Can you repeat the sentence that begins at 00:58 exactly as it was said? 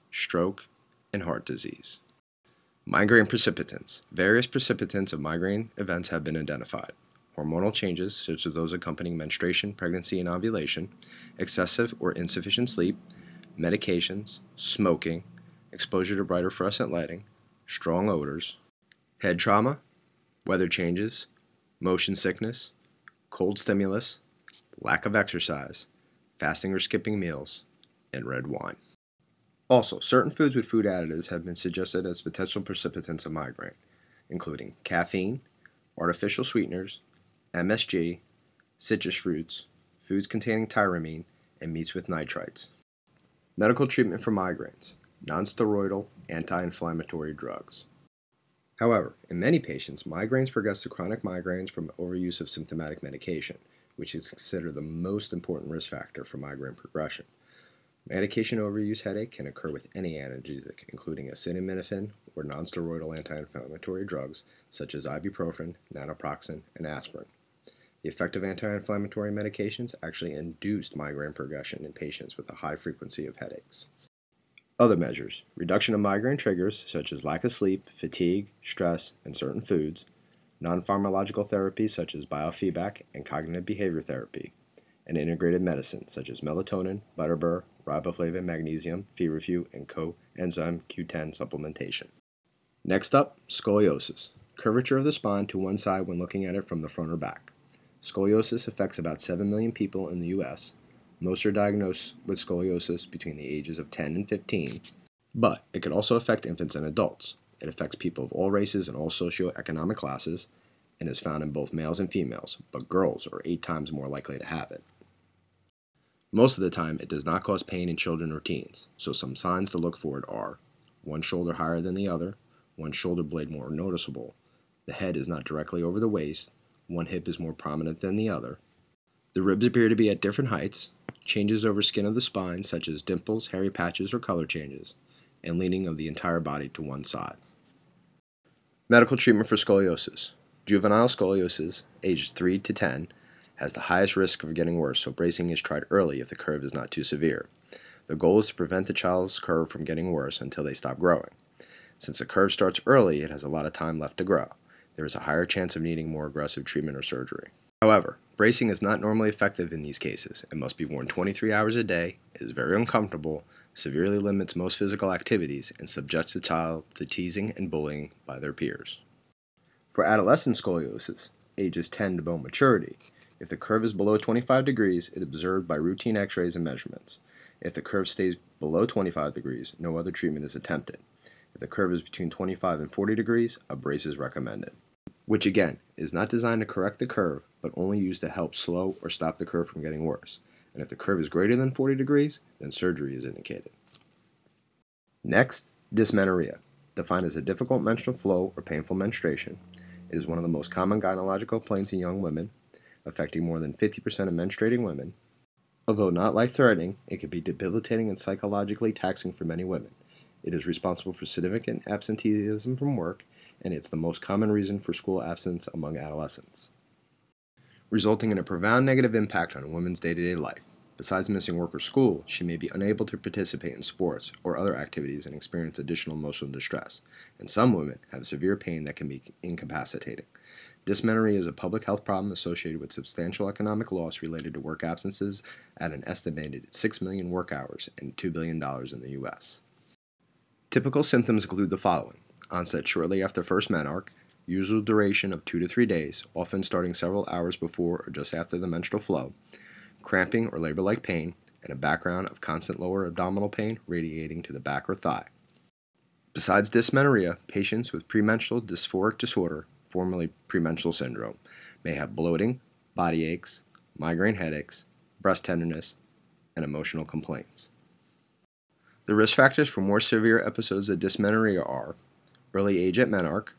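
Medication overuse headache can occur with any analgesic, including acetaminophen or nonsteroidal anti-inflammatory drugs such as ibuprofen, naproxen, and aspirin.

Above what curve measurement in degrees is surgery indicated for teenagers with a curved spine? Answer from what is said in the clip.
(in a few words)
40 degrees.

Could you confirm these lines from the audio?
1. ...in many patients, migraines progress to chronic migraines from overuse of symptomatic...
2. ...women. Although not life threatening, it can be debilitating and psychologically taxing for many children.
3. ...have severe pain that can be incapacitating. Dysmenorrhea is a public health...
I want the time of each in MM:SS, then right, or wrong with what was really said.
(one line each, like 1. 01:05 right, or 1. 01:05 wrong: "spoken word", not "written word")
1. 00:49 right
2. 03:24 wrong: "women", not "children"
3. 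03:48 right.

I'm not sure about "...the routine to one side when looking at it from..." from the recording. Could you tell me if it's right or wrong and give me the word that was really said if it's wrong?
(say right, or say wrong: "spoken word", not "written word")
wrong: "spine", not "routine".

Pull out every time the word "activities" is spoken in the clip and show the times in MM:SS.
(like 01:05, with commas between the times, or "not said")
02:45, 03:44.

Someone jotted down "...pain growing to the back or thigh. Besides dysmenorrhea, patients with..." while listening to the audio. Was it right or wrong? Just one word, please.
wrong.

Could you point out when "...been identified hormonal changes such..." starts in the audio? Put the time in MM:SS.
00:06.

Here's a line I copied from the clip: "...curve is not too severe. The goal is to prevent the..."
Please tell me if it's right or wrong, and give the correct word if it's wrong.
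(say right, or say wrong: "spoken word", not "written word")
right.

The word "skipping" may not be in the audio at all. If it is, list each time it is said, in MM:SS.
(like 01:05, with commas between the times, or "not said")
00:26.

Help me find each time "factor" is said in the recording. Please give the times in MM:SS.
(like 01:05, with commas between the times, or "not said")
00:55, 04:29.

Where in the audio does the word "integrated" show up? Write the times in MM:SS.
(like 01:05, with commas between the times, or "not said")
01:25.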